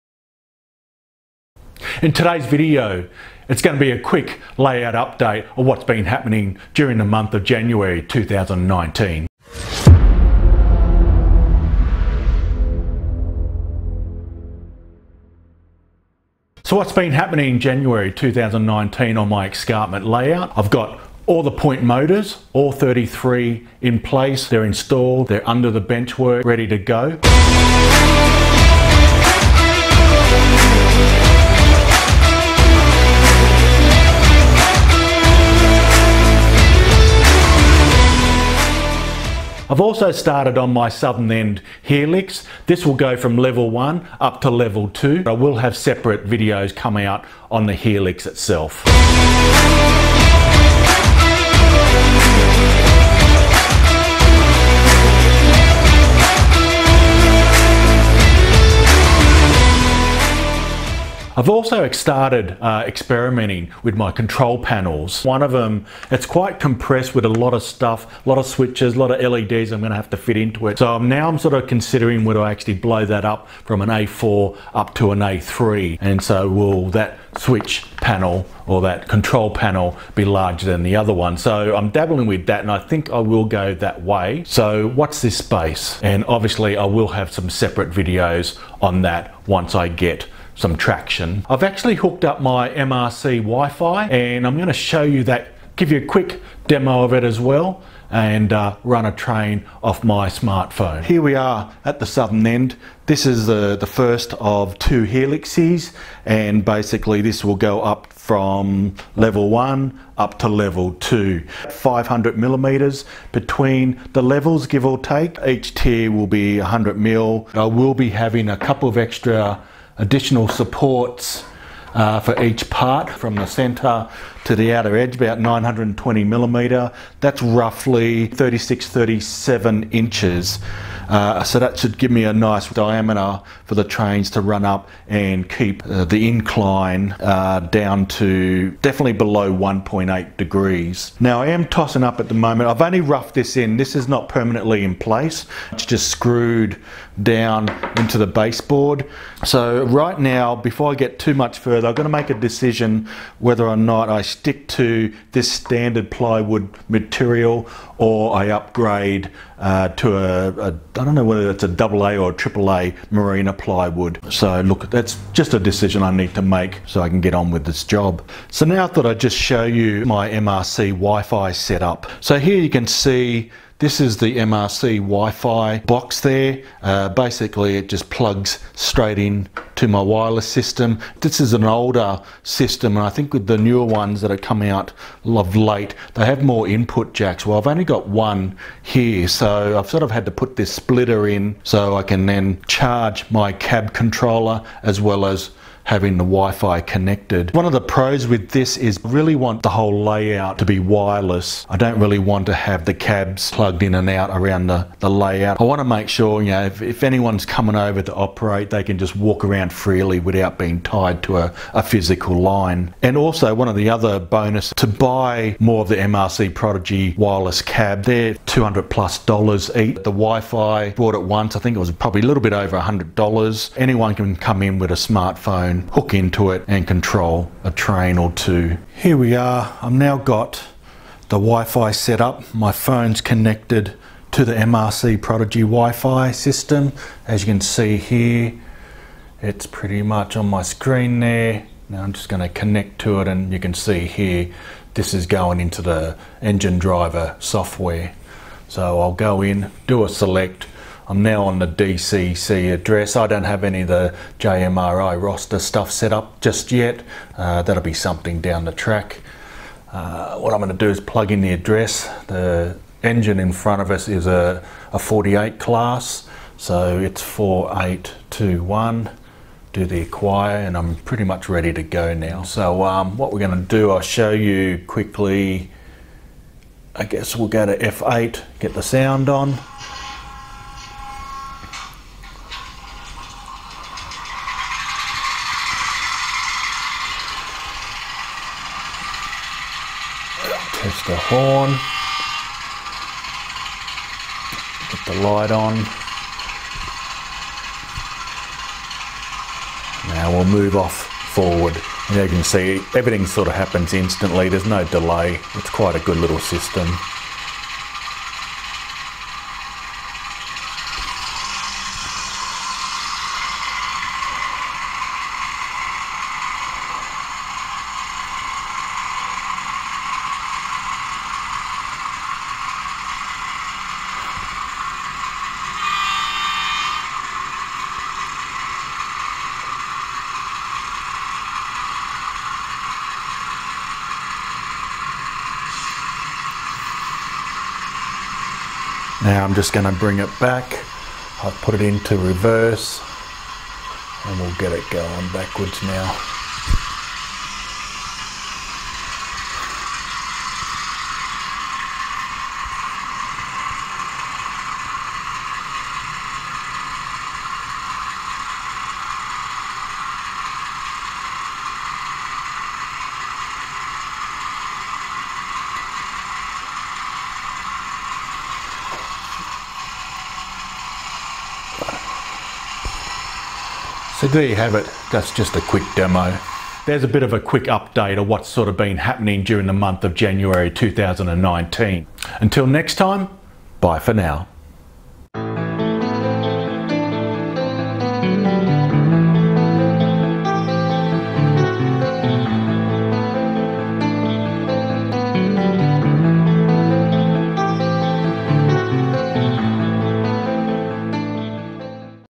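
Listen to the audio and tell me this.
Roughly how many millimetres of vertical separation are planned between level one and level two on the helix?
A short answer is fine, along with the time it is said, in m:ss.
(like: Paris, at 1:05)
500 millimeters, at 1:51.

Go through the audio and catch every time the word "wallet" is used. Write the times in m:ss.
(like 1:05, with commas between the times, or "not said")
not said.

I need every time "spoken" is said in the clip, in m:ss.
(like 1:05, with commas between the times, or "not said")
not said.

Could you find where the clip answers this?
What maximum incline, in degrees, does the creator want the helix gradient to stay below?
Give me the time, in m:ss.
2:19.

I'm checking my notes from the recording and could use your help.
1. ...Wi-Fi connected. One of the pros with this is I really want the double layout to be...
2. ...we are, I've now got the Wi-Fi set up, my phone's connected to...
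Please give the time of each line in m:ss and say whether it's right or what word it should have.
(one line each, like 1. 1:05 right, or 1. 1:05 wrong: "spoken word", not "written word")
1. 3:16 wrong: "whole", not "double"
2. 3:49 right.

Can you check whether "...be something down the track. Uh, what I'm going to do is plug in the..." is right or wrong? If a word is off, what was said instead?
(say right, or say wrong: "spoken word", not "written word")
right.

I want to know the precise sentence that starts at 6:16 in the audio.
There's a bit of a quick update of what's sort of been happening during the month of January 2019.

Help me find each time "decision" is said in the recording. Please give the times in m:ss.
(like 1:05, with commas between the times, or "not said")
2:32, 2:45.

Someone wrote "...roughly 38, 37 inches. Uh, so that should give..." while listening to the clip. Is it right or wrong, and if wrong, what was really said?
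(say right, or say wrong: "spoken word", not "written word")
wrong: "36", not "38".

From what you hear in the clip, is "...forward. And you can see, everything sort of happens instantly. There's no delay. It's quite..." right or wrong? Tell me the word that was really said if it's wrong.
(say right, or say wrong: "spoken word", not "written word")
right.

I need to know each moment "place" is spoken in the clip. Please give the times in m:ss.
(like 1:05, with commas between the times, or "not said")
0:23, 2:24.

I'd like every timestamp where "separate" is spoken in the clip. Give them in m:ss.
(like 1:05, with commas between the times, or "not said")
0:45, 1:27.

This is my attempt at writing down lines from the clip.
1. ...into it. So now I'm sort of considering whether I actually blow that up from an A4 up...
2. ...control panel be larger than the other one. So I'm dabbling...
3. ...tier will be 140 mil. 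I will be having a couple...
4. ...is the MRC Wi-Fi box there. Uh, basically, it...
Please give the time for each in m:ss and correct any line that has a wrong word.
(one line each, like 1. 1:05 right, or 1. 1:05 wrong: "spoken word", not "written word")
1. 1:10 right
2. 1:19 right
3. 1:55 wrong: "100", not "140"
4. 2:53 right.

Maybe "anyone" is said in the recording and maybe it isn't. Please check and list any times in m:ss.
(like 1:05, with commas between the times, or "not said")
3:27, 3:43.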